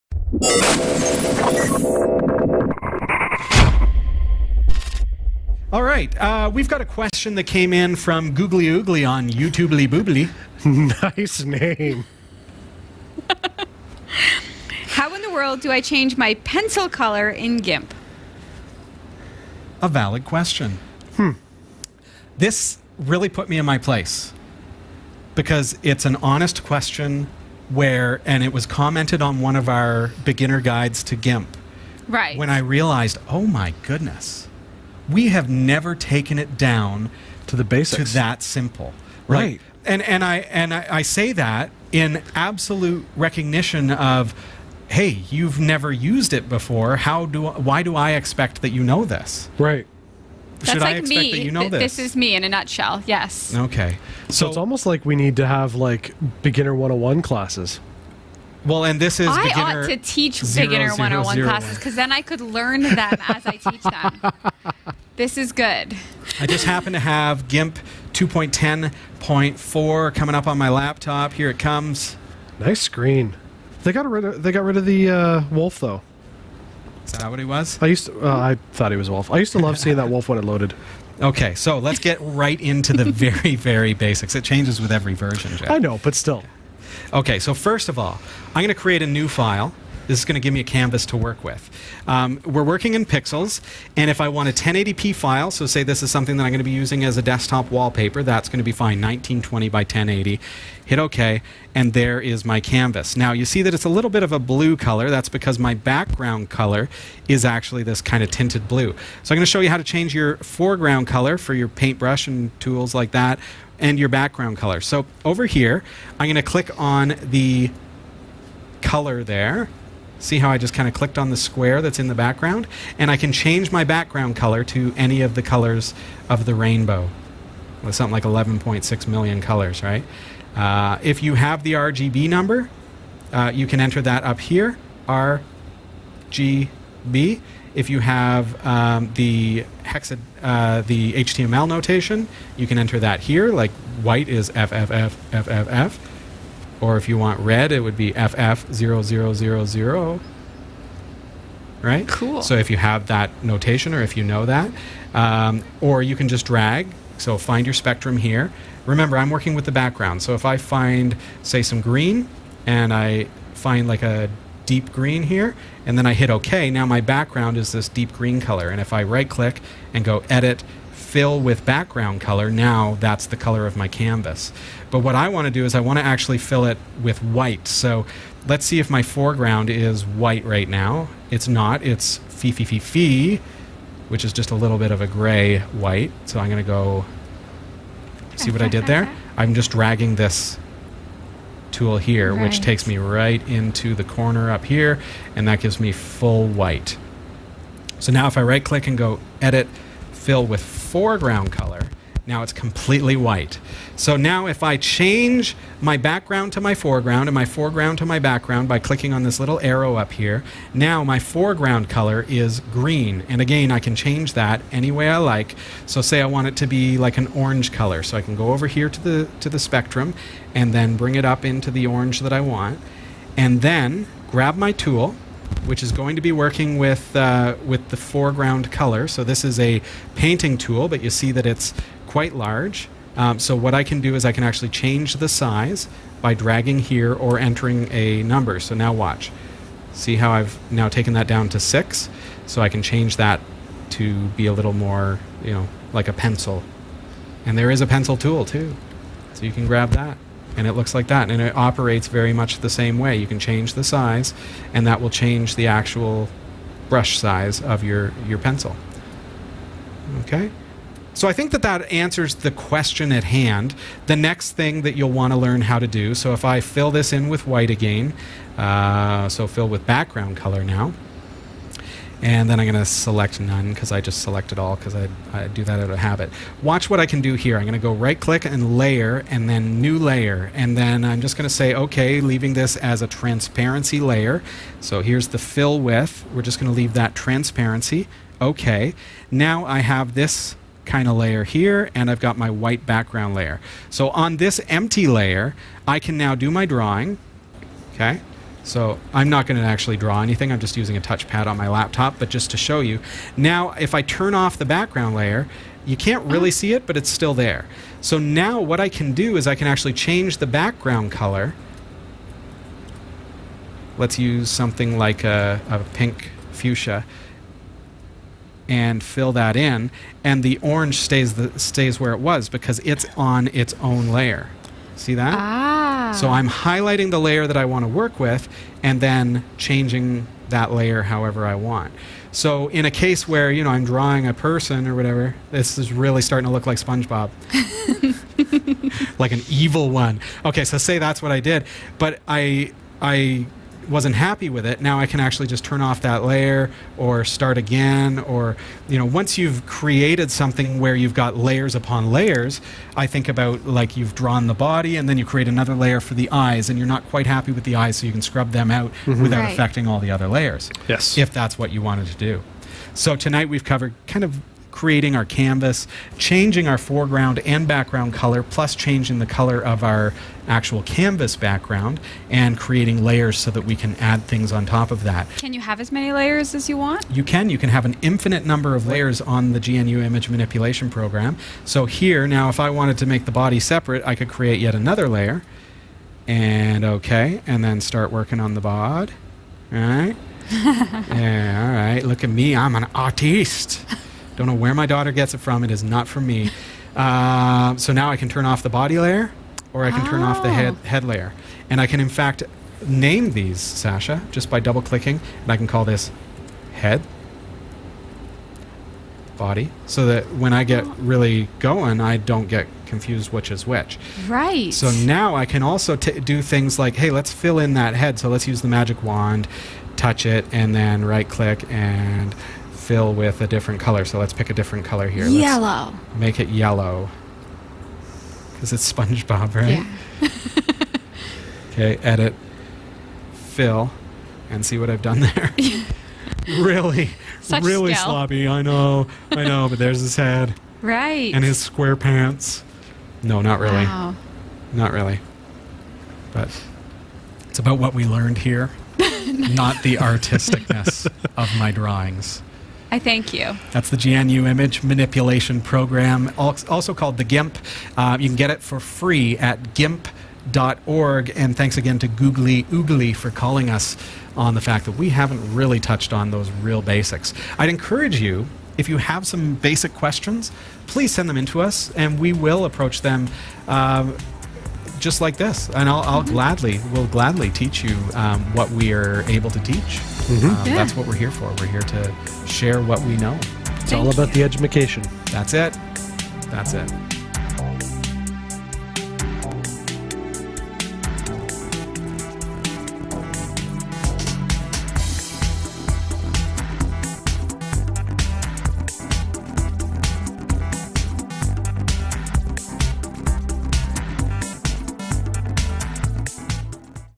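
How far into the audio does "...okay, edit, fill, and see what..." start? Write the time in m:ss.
7:11.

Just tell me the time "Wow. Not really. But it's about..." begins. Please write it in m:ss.
7:23.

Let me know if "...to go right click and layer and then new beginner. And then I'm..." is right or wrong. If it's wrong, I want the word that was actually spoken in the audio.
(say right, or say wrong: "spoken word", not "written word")
wrong: "layer", not "beginner".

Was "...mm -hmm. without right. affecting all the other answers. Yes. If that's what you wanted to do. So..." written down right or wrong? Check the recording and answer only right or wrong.
wrong.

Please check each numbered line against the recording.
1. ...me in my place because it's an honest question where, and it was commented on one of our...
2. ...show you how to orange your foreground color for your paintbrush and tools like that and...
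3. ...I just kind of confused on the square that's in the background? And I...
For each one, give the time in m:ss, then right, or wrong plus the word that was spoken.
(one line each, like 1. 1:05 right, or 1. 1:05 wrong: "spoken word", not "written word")
1. 0:23 right
2. 1:49 wrong: "change", not "orange"
3. 2:00 wrong: "clicked", not "confused".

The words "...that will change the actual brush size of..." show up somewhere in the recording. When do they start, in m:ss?
4:14.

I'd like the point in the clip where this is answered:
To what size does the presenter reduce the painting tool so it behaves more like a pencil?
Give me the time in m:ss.
4:01.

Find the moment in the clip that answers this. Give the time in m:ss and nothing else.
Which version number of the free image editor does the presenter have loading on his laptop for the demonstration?
1:08.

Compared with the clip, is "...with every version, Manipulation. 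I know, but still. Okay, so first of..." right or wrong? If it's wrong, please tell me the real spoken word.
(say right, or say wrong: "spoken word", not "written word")
wrong: "Jack", not "Manipulation".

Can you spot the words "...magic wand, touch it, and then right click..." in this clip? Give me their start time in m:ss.
6:58.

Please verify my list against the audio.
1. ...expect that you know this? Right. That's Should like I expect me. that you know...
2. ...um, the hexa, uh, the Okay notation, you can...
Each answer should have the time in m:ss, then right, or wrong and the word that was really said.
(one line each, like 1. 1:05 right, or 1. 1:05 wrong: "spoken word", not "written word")
1. 0:48 right
2. 2:18 wrong: "HTML", not "Okay".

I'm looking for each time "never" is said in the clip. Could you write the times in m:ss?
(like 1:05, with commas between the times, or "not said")
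0:35, 0:45.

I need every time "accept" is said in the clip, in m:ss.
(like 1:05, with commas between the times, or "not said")
not said.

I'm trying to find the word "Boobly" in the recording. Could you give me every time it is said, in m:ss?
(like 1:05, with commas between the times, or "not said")
0:09.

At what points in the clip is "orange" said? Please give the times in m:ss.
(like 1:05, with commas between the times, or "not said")
3:37, 3:41, 5:20.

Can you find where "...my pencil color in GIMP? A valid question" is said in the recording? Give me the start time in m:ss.
0:16.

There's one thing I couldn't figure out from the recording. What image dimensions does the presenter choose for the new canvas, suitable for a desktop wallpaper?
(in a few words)
1920 by 1080.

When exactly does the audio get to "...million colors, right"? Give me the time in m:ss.
2:09.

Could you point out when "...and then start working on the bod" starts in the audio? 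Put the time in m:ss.
6:27.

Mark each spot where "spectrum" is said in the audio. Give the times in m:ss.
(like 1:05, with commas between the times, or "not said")
2:37, 3:39.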